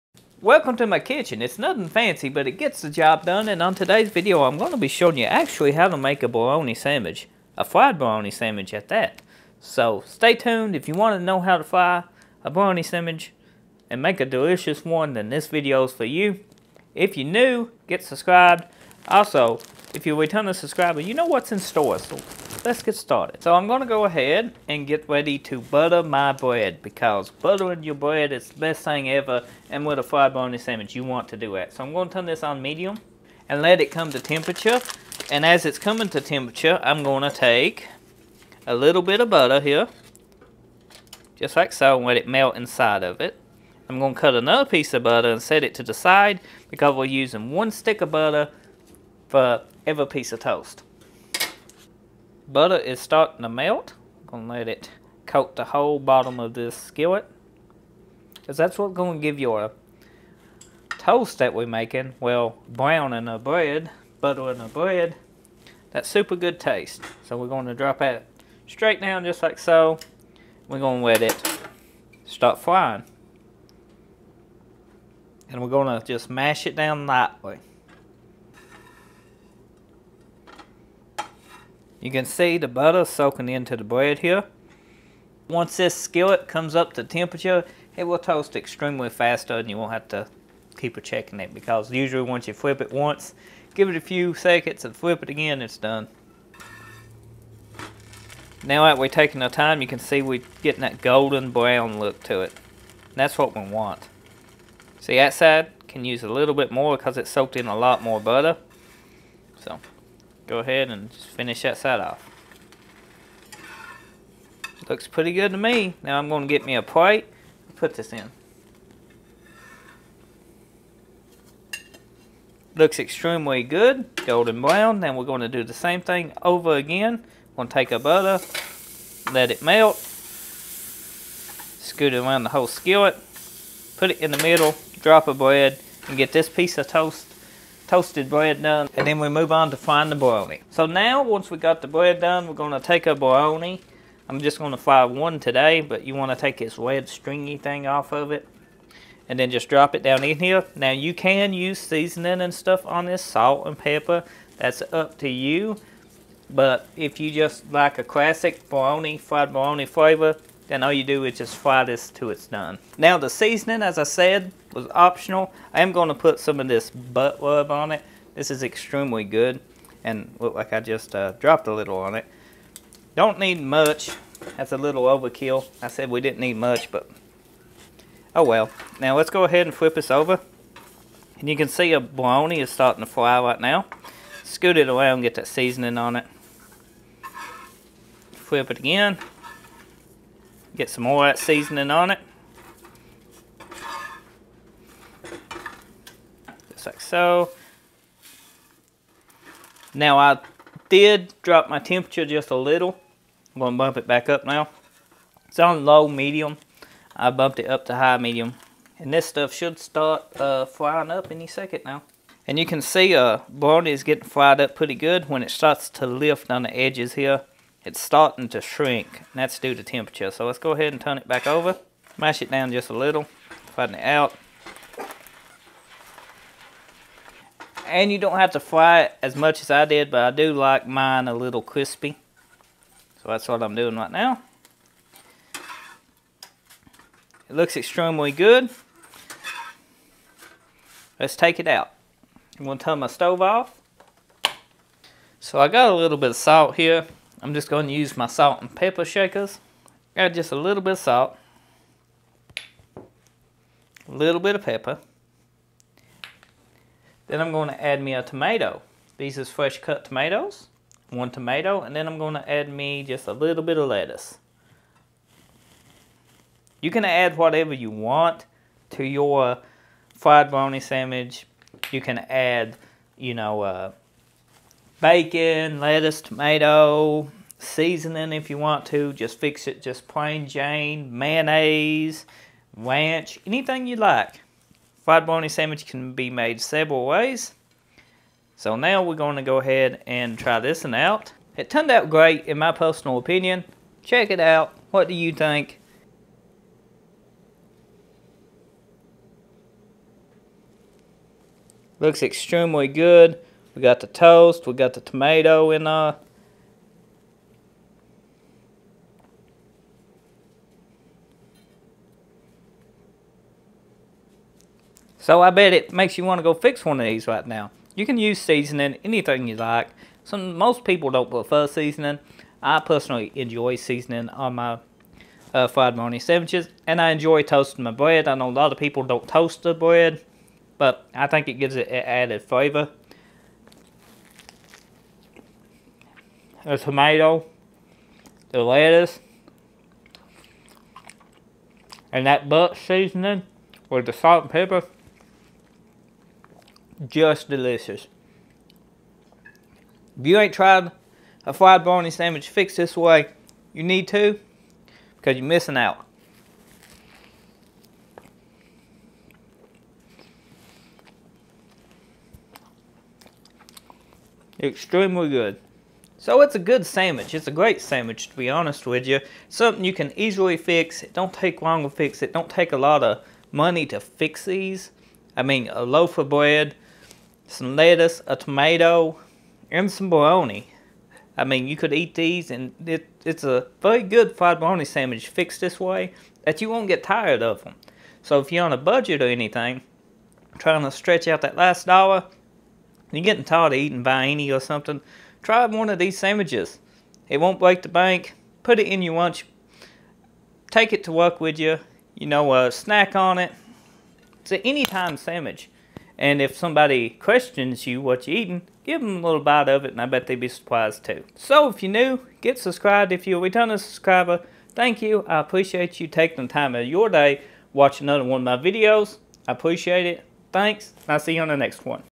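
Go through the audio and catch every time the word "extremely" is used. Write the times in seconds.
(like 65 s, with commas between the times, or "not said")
88 s, 122 s, 168 s, 237 s, 302 s, 364 s.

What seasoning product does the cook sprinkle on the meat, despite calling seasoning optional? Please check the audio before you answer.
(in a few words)
Butt rub.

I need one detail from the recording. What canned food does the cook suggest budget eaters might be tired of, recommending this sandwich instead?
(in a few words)
Vienna.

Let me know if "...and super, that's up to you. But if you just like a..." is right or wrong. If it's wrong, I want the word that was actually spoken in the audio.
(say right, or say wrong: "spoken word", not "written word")
wrong: "pepper", not "super".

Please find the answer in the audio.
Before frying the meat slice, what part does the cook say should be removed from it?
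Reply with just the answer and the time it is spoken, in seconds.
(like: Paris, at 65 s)
red stringy thing, at 146 s.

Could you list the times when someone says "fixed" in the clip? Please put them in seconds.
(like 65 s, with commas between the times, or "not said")
352 s, 385 s.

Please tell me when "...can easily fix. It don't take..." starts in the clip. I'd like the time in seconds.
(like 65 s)
369 s.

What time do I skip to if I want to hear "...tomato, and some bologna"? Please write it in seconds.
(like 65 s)
378 s.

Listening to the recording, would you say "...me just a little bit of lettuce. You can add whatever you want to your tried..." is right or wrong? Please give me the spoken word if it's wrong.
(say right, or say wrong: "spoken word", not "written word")
wrong: "fried", not "tried".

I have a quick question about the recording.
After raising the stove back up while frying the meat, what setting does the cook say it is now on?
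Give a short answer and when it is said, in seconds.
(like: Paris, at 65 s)
High, medium, at 207 s.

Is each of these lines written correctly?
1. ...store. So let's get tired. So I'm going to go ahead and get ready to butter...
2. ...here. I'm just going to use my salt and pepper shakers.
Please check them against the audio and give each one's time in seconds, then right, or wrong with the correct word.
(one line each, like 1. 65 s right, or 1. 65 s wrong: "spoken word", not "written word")
1. 21 s wrong: "started", not "tired"
2. 246 s right.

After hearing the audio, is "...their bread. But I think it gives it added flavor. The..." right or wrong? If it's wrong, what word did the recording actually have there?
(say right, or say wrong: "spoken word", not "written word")
right.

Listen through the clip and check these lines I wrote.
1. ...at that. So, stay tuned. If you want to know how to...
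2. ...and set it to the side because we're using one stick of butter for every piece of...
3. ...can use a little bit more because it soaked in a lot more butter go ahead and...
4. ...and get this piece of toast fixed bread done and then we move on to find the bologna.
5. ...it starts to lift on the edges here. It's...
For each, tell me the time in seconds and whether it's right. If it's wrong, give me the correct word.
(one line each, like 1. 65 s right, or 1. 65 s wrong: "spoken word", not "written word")
1. 8 s right
2. 45 s right
3. 105 s right
4. 136 s wrong: "toasted", not "fixed"
5. 215 s right.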